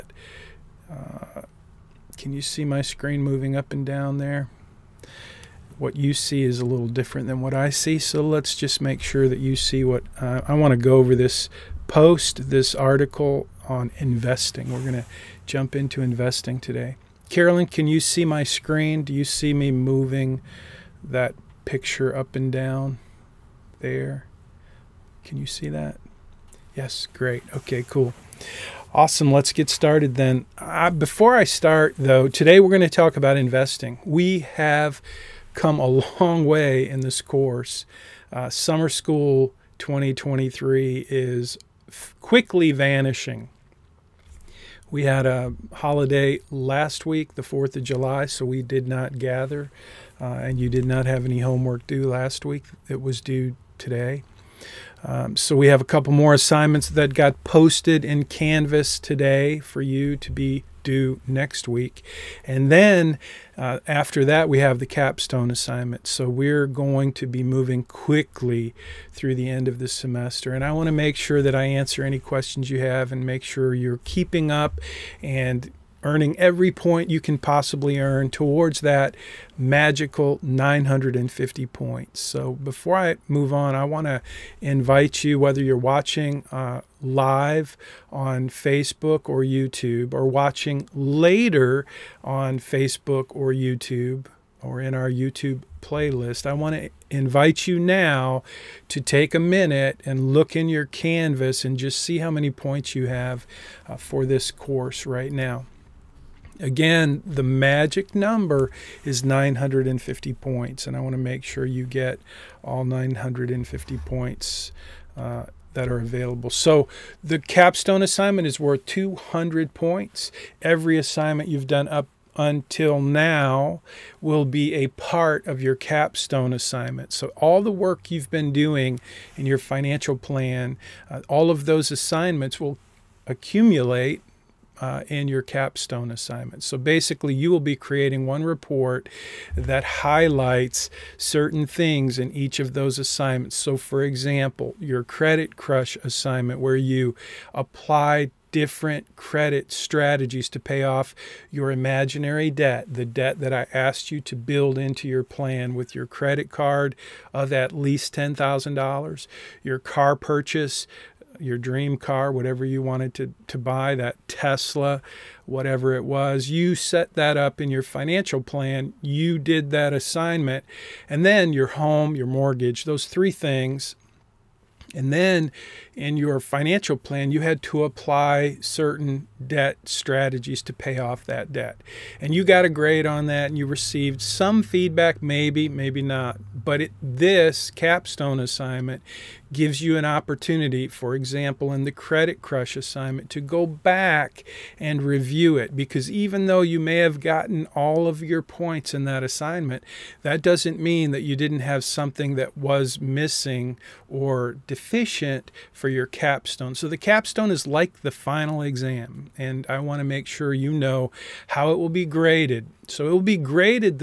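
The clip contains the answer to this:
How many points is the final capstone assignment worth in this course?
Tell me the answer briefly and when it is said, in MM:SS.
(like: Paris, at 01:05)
200, at 01:58.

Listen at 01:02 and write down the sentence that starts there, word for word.
And then uh, after that, we have the capstone assignment.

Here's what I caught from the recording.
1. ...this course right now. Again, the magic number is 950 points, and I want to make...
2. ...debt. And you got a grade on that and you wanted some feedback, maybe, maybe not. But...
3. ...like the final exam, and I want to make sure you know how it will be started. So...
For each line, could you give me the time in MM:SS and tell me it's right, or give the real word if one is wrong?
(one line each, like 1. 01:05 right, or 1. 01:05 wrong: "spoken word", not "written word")
1. 01:44 right
2. 03:01 wrong: "received", not "wanted"
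3. 03:27 wrong: "graded", not "started".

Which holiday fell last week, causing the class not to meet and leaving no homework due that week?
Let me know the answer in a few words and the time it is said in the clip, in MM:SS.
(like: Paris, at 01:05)
4th of July, at 00:47.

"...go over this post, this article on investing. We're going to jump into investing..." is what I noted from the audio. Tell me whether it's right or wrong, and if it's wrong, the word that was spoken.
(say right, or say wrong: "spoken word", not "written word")
right.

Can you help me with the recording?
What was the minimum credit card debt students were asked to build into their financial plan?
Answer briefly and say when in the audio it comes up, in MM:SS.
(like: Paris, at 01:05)
$10,000, at 02:38.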